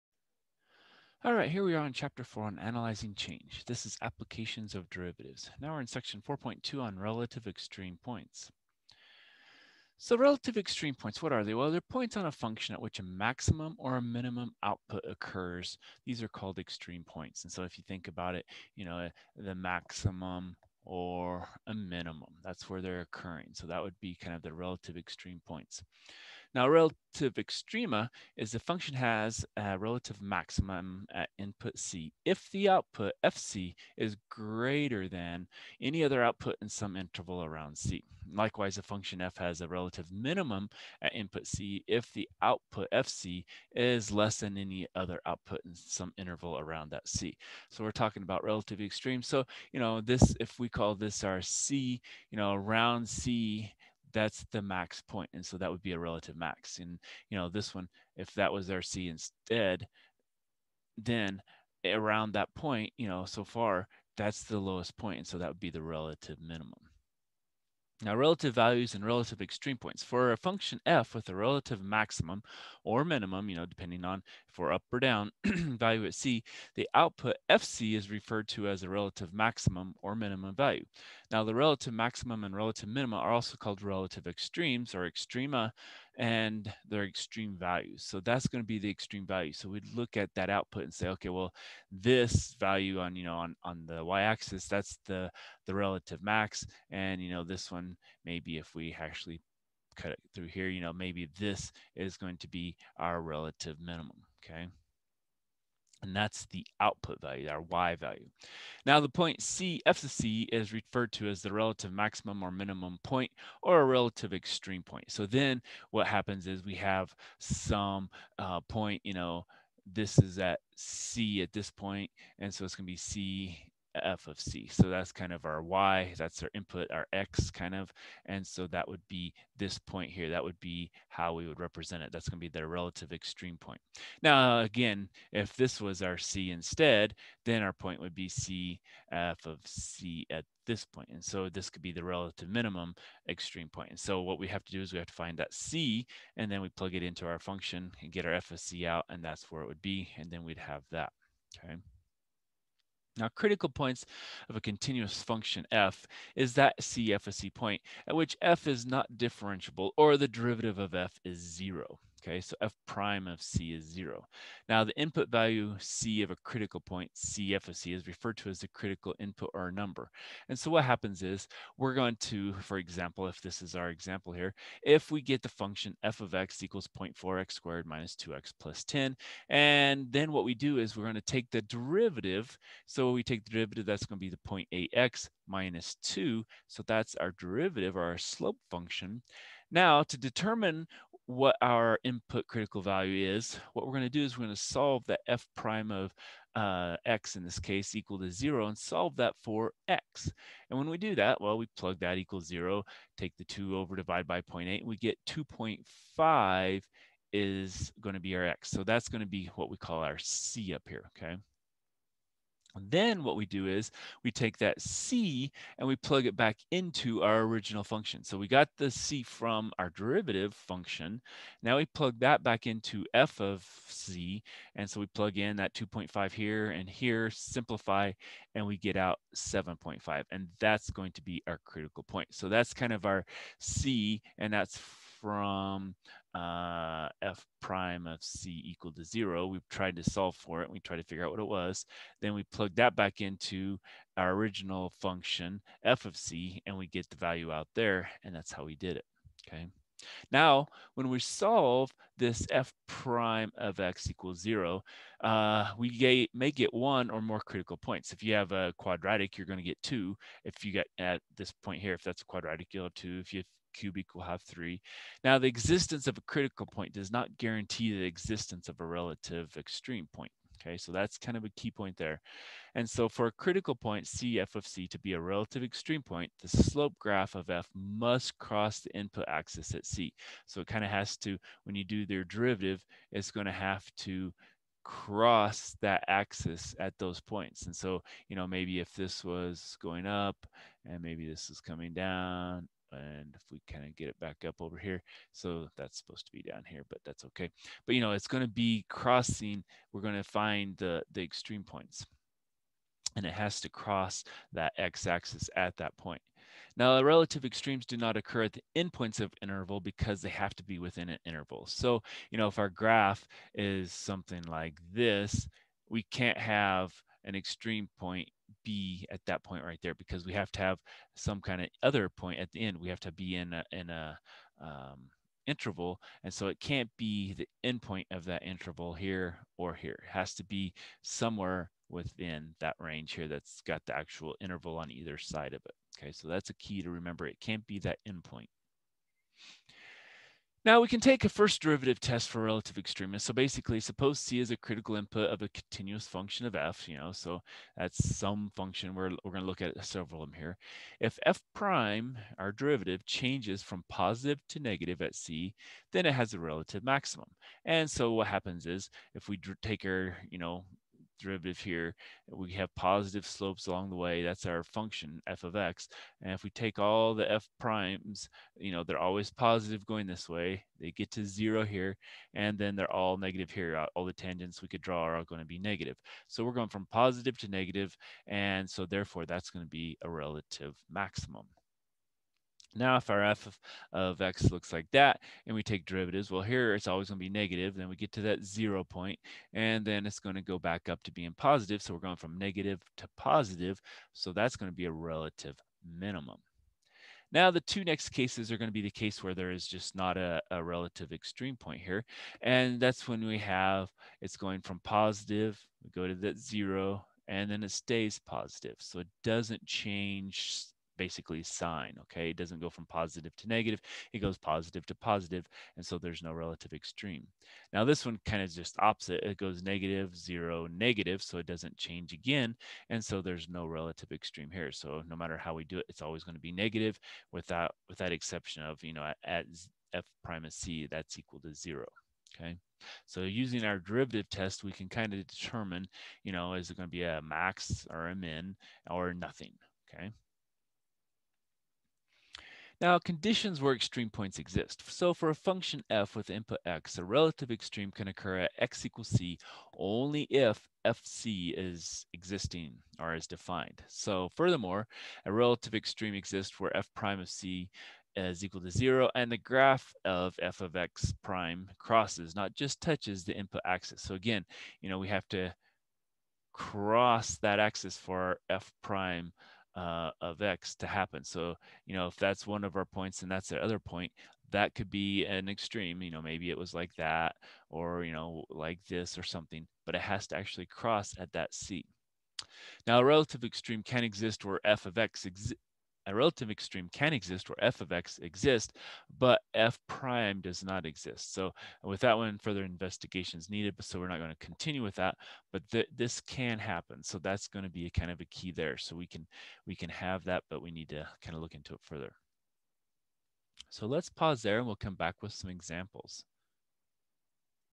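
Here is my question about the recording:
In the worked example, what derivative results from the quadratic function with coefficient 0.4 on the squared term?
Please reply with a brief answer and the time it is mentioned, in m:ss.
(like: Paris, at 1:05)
0.8x - 2, at 3:04.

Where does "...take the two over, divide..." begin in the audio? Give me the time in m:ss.
3:23.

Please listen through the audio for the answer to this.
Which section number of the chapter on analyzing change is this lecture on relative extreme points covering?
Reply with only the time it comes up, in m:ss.
0:06.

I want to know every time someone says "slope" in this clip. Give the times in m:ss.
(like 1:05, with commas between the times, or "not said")
3:08, 4:36, 6:03.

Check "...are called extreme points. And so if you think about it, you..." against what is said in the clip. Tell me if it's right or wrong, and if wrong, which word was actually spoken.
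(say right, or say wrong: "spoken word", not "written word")
right.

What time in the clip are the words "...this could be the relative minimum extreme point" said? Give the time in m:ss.
2:21.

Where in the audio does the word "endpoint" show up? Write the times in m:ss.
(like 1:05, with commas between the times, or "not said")
5:08, 5:27, 5:38.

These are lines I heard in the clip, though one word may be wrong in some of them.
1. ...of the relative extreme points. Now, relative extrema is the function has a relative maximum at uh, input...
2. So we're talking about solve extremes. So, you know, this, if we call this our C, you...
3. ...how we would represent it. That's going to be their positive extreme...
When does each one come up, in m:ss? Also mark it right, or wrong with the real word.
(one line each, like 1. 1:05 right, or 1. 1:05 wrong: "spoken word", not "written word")
1. 0:24 right
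2. 0:47 wrong: "relative", not "solve"
3. 2:11 wrong: "relative", not "positive".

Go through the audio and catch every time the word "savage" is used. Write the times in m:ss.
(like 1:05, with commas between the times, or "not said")
not said.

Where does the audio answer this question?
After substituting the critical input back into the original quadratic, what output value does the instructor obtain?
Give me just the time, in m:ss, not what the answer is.
3:49.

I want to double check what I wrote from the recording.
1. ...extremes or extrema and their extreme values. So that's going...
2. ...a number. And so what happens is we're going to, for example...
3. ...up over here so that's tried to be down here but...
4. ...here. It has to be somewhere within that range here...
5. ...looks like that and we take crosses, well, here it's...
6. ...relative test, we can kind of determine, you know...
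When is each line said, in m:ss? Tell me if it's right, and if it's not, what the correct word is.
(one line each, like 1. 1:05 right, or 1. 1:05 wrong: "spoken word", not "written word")
1. 1:24 right
2. 2:49 right
3. 4:54 wrong: "supposed", not "tried"
4. 5:29 right
5. 6:24 wrong: "derivatives", not "crosses"
6. 7:13 wrong: "derivative", not "relative".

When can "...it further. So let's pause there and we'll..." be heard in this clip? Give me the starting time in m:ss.
8:21.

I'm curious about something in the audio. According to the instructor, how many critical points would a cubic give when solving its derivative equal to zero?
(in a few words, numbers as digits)
3.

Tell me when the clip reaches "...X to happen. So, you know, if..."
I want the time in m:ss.
7:50.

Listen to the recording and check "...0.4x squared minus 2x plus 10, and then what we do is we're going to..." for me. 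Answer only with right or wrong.
right.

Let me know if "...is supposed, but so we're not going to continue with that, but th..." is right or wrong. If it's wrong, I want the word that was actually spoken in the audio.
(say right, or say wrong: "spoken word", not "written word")
wrong: "needed", not "supposed".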